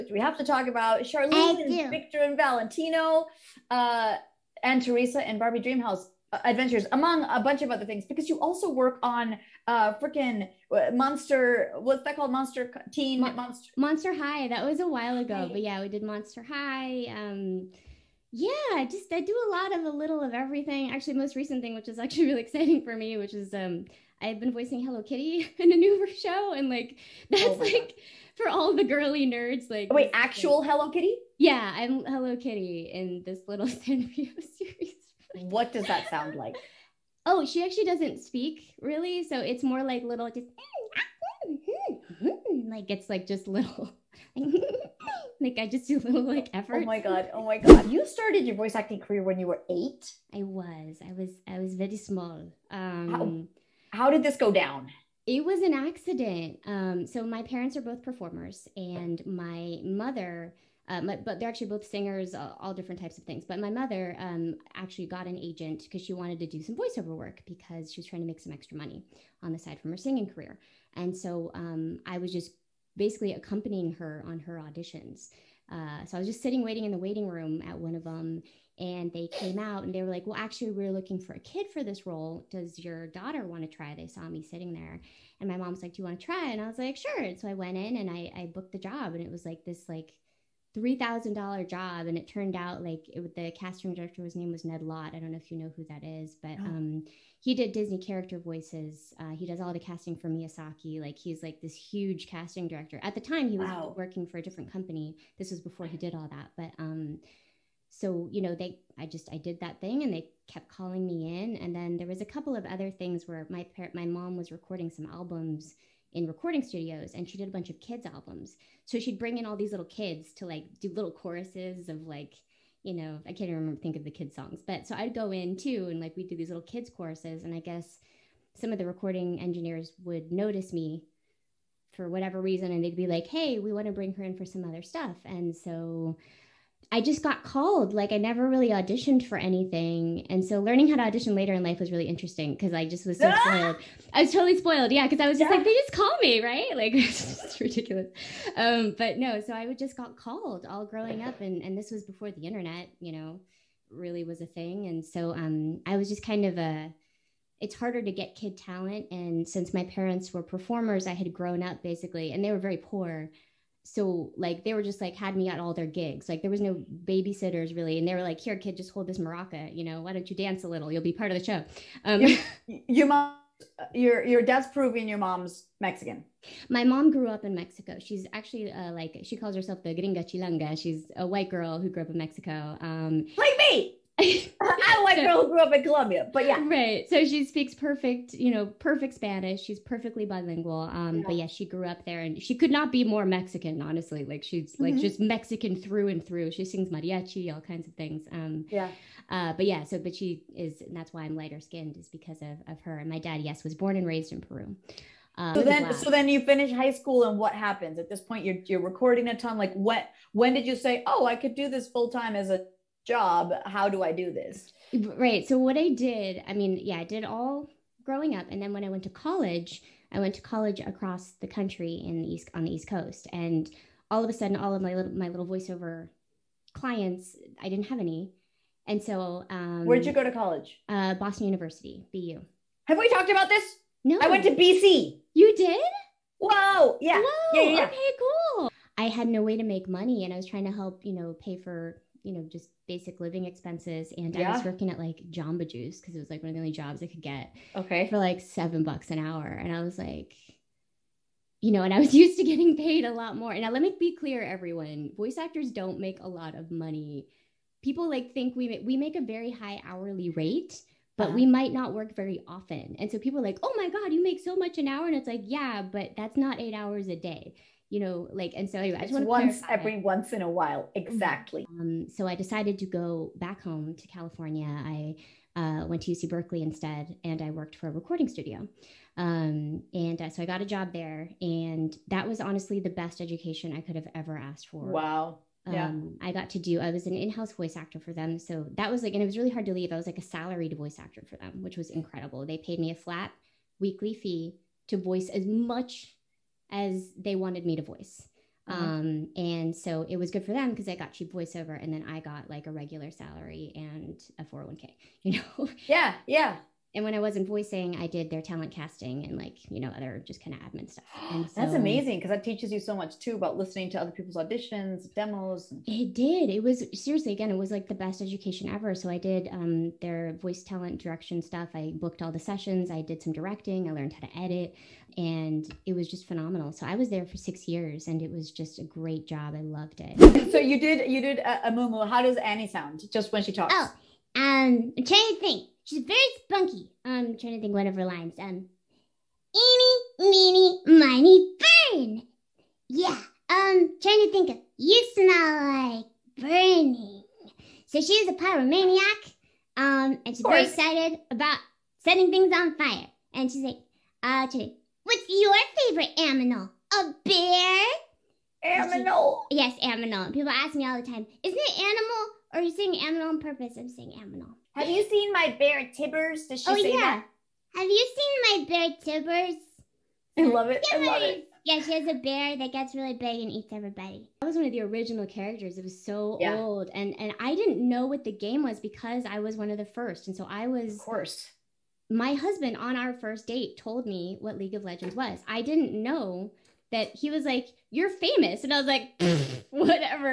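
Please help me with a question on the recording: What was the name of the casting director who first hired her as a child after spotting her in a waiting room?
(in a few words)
Ned Lott.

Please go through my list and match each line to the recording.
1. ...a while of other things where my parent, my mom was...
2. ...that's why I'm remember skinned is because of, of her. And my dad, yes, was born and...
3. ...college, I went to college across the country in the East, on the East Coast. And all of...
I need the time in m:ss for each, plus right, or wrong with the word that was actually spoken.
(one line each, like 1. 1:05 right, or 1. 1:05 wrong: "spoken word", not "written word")
1. 1:52 wrong: "couple", not "while"
2. 3:20 wrong: "lighter", not "remember"
3. 3:39 right.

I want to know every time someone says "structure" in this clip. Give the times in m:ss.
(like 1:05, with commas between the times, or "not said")
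not said.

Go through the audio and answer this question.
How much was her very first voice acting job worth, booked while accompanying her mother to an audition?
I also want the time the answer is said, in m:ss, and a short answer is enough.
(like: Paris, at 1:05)
$3,000, at 1:30.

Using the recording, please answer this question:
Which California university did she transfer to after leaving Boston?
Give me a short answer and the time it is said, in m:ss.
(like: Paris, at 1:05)
UC Berkeley, at 4:36.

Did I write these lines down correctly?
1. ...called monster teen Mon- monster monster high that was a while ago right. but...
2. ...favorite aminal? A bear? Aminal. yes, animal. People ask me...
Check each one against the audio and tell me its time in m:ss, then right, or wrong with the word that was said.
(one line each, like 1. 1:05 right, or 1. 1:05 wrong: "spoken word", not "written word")
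1. 0:12 right
2. 5:55 wrong: "aminal", not "animal".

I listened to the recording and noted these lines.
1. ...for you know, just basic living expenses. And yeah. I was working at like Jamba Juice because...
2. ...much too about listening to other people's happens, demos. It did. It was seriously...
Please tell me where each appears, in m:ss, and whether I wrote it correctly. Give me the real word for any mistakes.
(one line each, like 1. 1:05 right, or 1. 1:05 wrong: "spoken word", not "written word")
1. 4:01 right
2. 5:12 wrong: "auditions", not "happens".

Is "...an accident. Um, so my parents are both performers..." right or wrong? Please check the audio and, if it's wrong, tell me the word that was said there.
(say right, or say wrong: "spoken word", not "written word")
right.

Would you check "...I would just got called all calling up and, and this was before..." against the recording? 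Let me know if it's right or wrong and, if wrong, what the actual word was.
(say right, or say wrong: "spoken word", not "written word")
wrong: "growing", not "calling".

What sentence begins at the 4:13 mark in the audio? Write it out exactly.
And now let me be clear, everyone voice actors don't make a lot of money.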